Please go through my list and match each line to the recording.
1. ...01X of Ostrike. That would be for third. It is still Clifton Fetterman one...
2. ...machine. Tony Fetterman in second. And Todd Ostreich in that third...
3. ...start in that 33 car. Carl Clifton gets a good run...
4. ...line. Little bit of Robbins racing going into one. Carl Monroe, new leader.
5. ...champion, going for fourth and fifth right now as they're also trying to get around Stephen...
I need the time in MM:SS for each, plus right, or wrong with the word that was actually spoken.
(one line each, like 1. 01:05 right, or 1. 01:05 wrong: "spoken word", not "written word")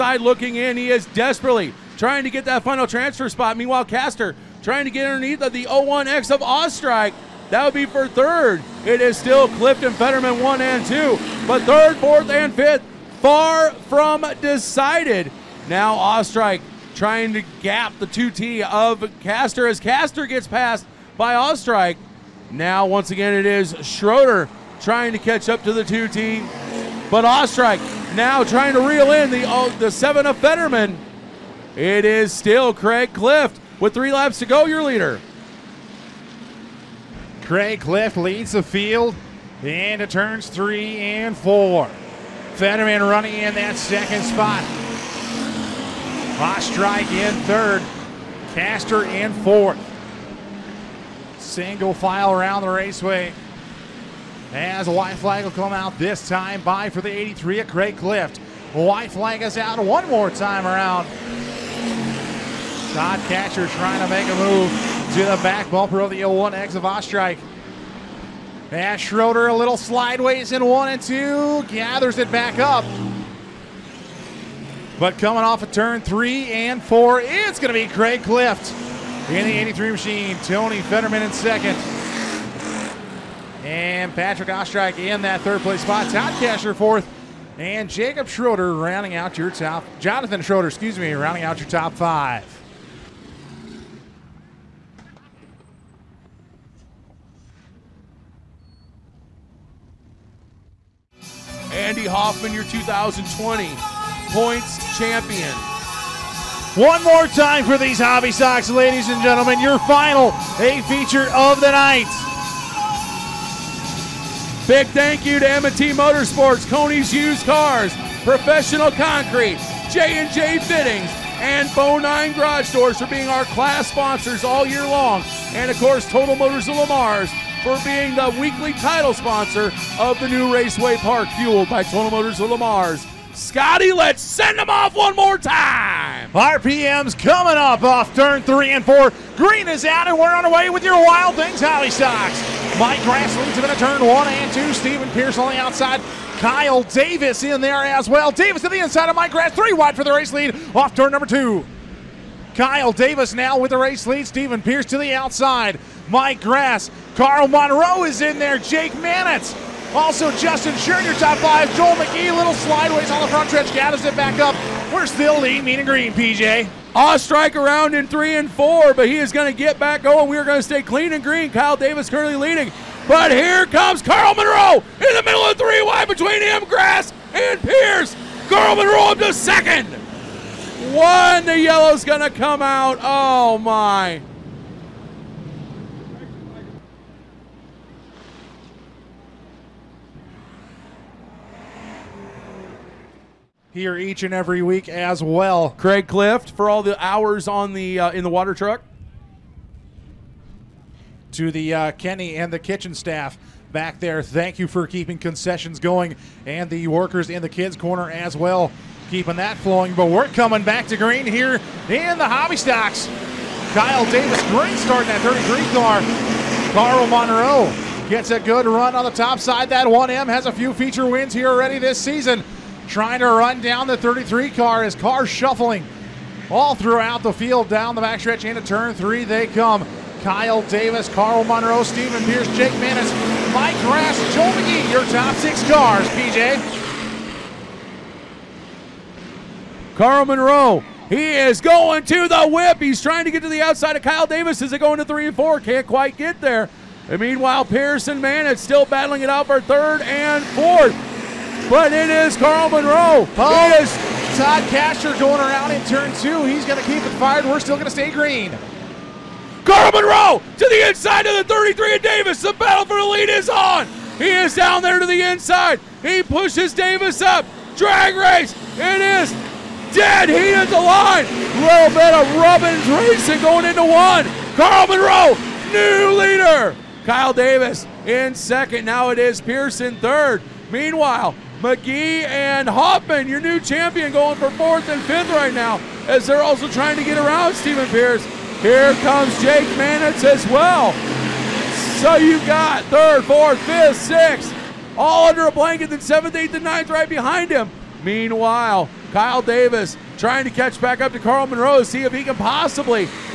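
1. 00:05 right
2. 01:19 wrong: "Patrick", not "Todd"
3. 03:34 wrong: "Monroe", not "Clifton"
4. 04:30 right
5. 04:43 right.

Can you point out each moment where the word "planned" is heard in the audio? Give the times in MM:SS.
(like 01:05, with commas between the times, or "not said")
not said.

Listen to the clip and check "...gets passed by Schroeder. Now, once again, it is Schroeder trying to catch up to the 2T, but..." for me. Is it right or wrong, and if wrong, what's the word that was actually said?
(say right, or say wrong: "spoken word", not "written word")
wrong: "Ostrike", not "Schroeder".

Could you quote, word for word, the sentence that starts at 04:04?
Is it going to three and four?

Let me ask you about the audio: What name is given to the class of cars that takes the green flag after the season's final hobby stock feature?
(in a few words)
Wild Things Hobby Stocks.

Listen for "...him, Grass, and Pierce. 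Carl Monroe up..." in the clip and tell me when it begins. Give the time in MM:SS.
02:56.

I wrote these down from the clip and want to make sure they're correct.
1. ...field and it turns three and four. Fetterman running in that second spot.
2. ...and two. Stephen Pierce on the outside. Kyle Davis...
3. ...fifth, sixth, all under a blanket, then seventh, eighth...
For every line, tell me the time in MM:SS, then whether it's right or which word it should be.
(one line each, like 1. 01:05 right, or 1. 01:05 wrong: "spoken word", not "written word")
1. 00:38 right
2. 02:24 right
3. 04:53 right.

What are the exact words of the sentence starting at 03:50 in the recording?
Kyle Davis, Carl Monroe, Stephen Pierce, Jake Manis, Mike Grass, Joel McGee, your top six cars, PJ.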